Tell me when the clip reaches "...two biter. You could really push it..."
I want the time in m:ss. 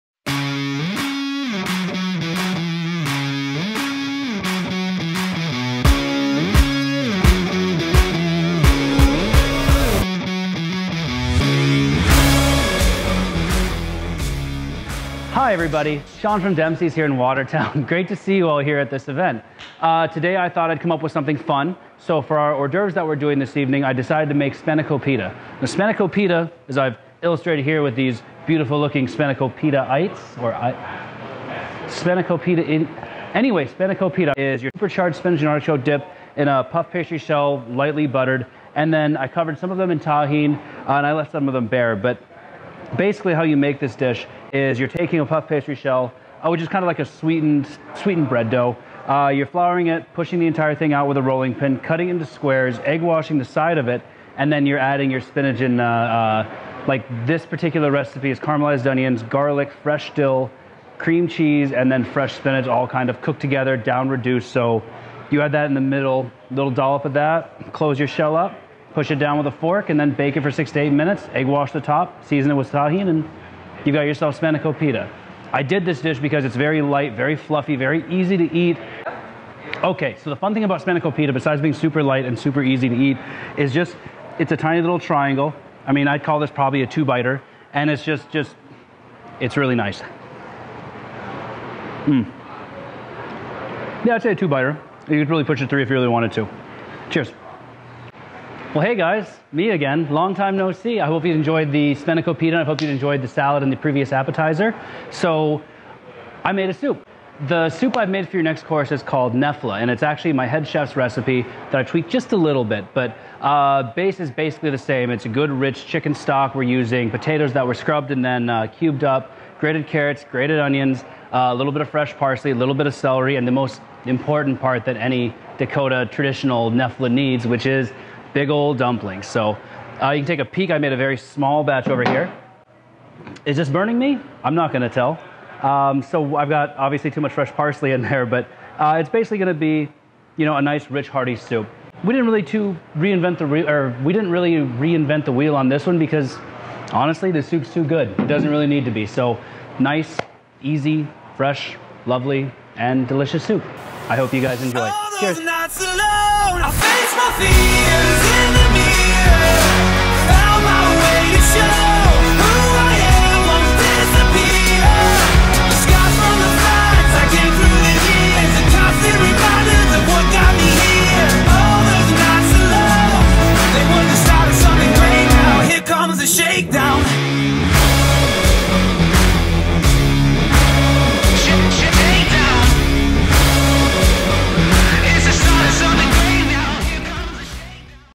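1:34.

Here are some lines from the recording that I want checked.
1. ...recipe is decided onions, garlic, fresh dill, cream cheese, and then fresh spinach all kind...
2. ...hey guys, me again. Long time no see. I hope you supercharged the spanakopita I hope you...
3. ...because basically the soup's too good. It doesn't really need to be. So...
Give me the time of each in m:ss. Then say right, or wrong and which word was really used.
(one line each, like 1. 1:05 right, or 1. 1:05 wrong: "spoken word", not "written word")
1. 0:57 wrong: "caramelized", not "decided"
2. 1:38 wrong: "enjoyed", not "supercharged"
3. 2:25 wrong: "honestly", not "basically".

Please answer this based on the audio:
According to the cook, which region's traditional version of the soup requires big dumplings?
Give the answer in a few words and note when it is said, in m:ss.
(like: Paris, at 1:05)
Dakota, at 2:05.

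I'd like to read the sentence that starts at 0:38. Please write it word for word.
And then I covered some of them in tahine, uh, and I left some of them bare.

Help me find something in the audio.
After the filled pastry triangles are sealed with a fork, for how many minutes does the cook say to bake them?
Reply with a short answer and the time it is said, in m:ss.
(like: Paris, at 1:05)
6 to 8 minutes, at 1:10.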